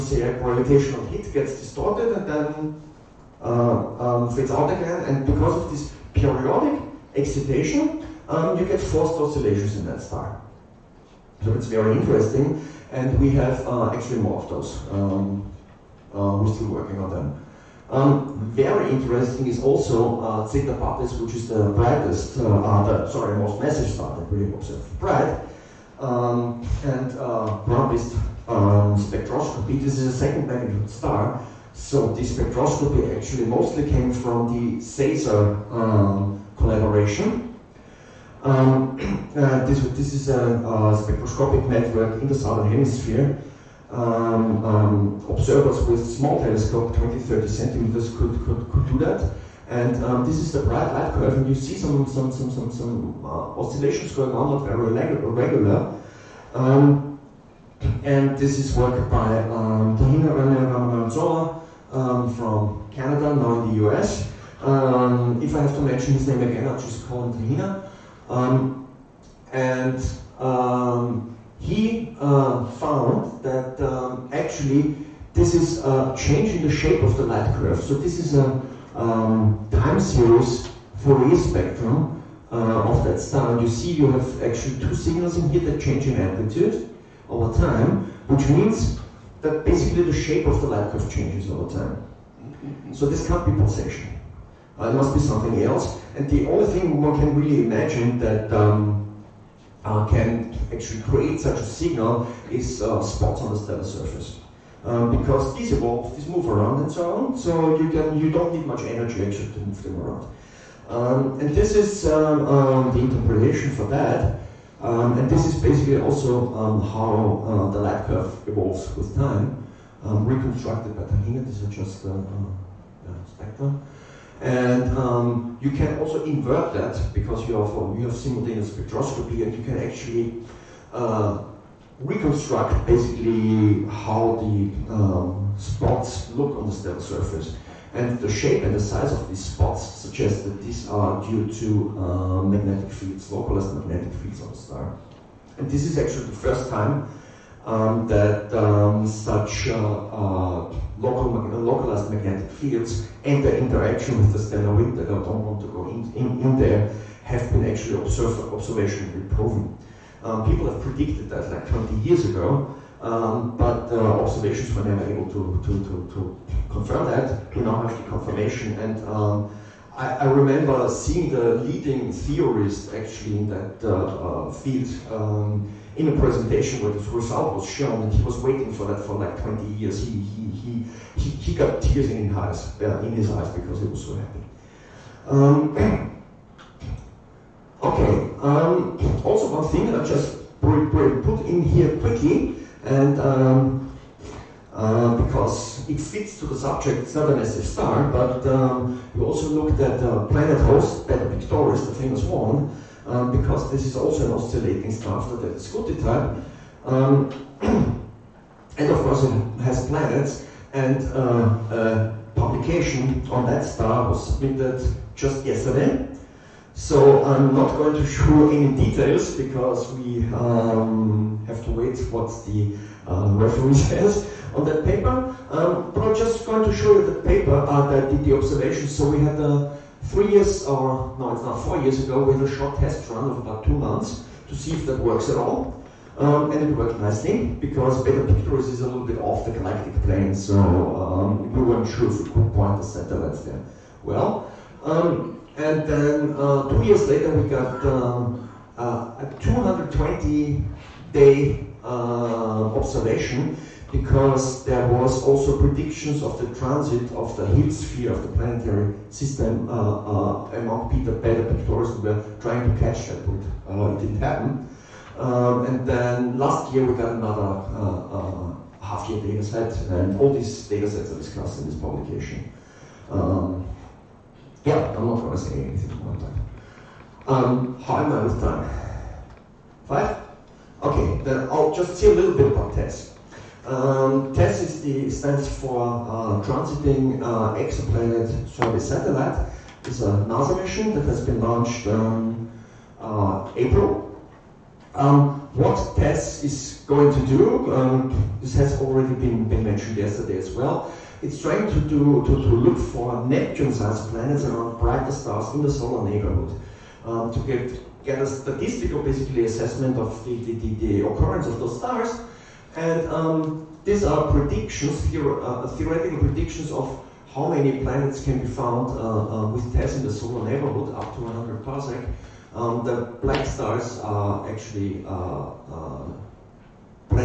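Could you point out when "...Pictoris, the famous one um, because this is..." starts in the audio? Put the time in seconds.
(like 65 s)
201 s.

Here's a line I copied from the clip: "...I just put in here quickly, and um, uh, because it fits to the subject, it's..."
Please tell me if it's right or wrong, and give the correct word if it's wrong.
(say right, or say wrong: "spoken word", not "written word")
right.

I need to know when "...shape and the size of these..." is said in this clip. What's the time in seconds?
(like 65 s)
138 s.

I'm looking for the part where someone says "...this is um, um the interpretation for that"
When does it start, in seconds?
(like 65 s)
111 s.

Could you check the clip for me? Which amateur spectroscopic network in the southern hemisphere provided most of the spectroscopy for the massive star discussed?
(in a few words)
CESAR.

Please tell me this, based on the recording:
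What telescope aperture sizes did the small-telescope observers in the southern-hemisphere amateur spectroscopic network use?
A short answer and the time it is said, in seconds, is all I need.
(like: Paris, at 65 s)
20 to 30 centimeters, at 46 s.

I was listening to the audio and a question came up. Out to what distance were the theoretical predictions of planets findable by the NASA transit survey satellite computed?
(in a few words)
100 parsec.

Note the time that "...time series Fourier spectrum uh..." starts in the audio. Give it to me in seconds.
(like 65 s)
79 s.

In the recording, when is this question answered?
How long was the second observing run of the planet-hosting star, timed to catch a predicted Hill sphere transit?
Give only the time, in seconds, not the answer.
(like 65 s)
249 s.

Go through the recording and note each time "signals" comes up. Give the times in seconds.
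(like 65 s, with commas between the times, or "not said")
84 s, 101 s.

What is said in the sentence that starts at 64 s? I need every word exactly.
Um, if I have to mention his name again, I'll just call him Tahina.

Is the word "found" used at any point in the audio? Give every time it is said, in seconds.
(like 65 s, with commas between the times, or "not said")
72 s, 318 s.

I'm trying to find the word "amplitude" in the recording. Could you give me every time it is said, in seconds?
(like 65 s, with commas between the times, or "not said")
86 s.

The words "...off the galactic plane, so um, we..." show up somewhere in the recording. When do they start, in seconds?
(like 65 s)
239 s.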